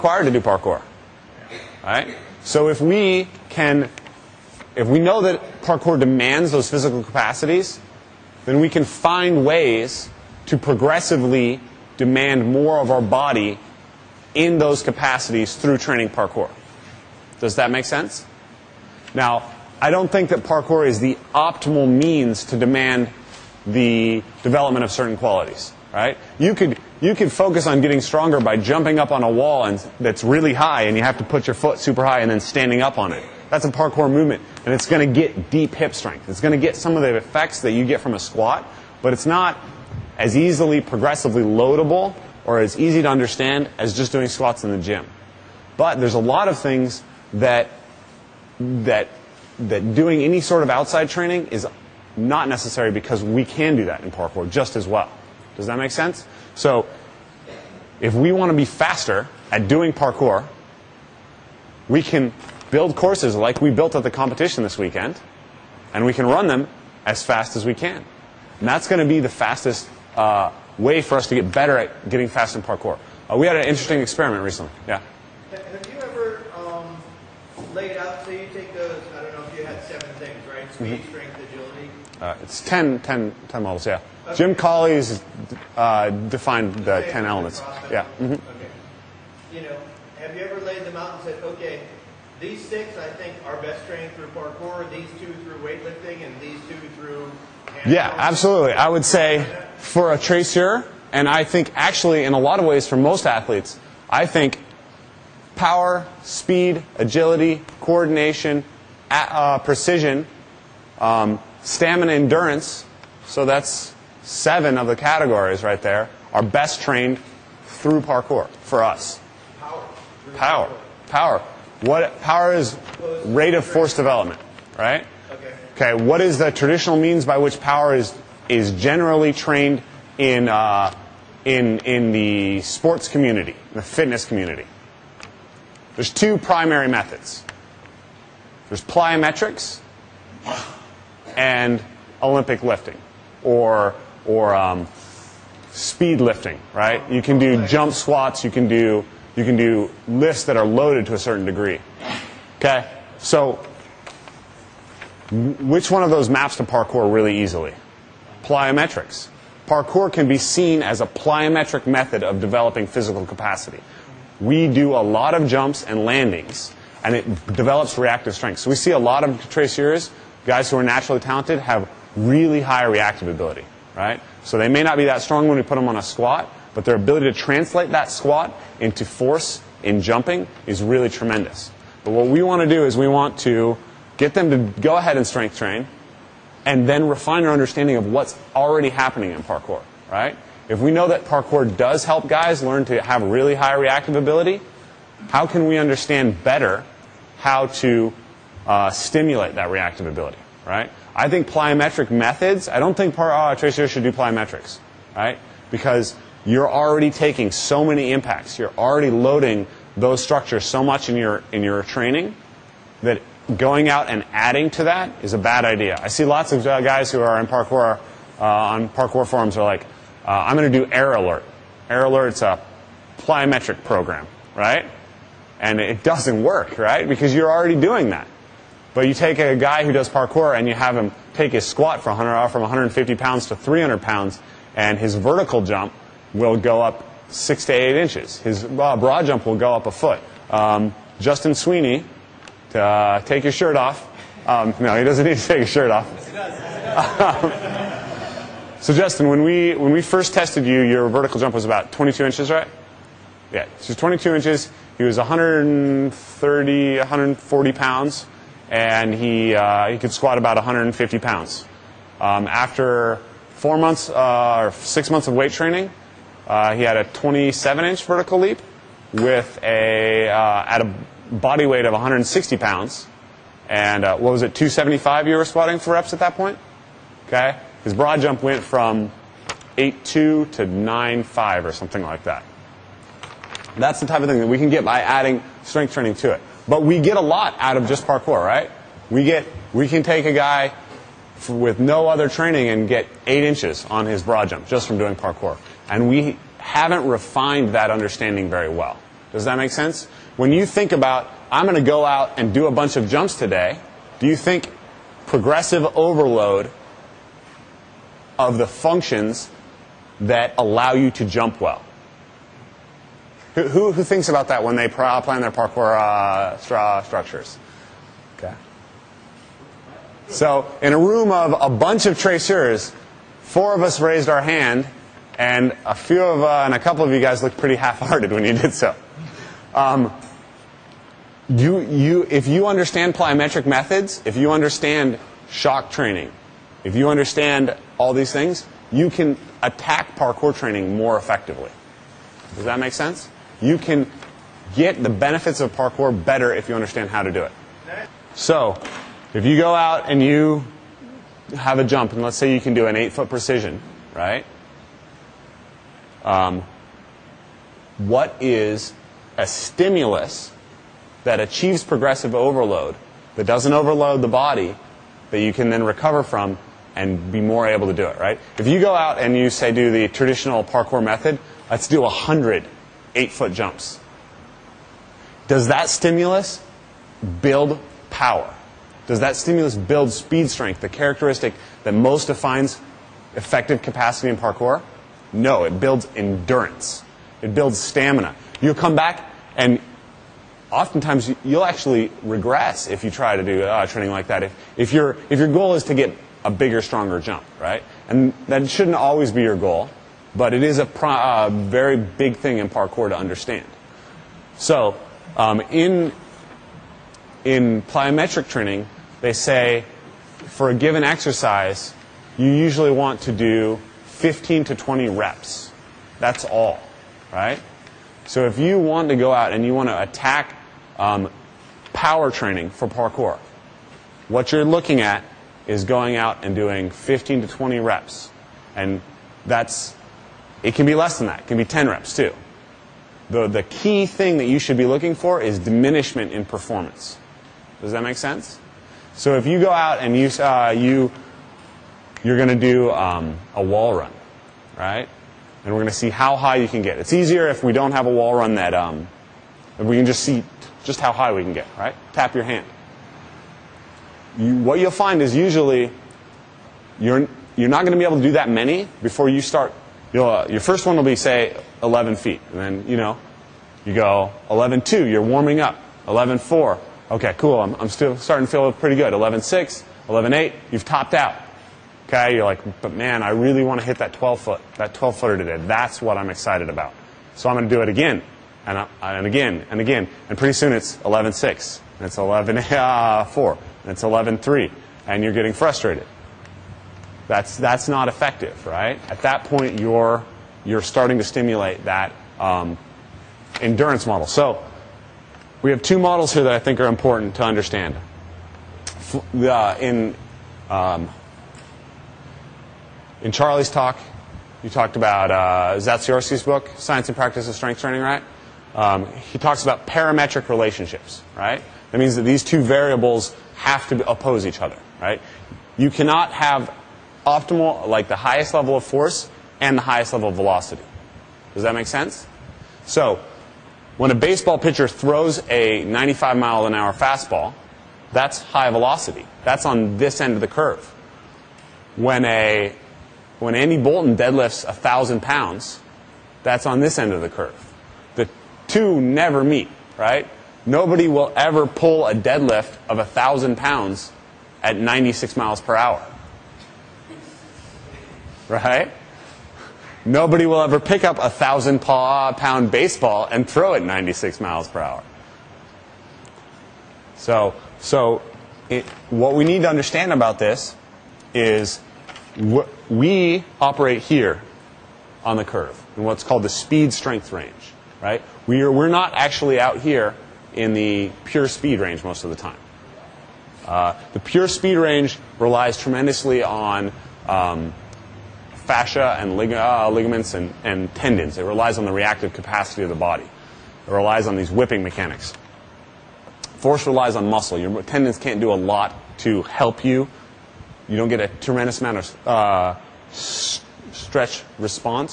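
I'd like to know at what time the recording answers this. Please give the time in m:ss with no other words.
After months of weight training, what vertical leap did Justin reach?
4:27.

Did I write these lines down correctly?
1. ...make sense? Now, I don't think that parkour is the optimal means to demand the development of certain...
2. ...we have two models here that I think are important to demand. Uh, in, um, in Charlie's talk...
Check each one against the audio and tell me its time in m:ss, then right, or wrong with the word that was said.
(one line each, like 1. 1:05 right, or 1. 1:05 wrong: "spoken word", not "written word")
1. 0:17 right
2. 8:15 wrong: "understand", not "demand".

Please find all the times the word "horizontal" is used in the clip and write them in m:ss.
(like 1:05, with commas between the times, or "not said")
not said.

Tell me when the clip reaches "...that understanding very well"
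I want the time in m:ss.
4:57.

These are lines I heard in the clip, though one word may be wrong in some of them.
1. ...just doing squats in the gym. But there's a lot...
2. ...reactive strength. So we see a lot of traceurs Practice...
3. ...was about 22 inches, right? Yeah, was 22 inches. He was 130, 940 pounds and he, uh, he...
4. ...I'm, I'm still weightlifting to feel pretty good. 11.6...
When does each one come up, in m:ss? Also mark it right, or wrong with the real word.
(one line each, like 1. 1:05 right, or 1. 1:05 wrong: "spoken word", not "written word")
1. 0:43 right
2. 2:47 wrong: "Guys", not "Practice"
3. 4:11 wrong: "140", not "940"
4. 7:47 wrong: "starting", not "weightlifting".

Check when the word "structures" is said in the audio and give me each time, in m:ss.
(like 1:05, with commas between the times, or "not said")
3:30, 5:17.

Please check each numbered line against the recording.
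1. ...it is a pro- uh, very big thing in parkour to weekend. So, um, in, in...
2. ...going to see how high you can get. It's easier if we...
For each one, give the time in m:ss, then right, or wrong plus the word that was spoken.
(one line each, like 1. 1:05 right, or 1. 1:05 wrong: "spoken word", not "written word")
1. 6:40 wrong: "understand", not "weekend"
2. 7:25 right.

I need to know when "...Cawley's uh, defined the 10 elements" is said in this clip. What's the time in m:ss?
1:24.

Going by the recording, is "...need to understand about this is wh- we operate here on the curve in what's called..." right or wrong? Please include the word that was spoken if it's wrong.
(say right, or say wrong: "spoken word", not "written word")
right.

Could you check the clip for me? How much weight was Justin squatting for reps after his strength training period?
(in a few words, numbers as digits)
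275.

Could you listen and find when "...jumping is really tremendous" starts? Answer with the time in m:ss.
3:00.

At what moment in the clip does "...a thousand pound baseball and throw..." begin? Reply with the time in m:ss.
9:11.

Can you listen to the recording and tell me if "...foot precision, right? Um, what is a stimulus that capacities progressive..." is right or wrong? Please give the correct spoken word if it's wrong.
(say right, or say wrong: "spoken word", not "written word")
wrong: "achieves", not "capacities".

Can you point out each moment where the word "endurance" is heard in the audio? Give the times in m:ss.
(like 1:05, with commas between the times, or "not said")
1:52, 6:26, 8:13.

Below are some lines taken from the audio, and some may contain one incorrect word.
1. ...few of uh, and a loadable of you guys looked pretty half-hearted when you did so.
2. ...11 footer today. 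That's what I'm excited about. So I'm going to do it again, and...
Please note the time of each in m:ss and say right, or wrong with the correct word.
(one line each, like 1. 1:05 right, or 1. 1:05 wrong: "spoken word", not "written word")
1. 5:25 wrong: "couple", not "loadable"
2. 7:54 wrong: "12", not "11".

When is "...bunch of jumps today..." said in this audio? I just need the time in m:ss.
5:02.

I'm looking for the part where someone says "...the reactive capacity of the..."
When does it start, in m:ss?
9:41.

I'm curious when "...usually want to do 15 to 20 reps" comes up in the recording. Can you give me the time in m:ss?
6:52.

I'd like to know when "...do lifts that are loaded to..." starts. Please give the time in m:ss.
2:29.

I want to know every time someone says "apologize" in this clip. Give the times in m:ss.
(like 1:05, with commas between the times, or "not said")
not said.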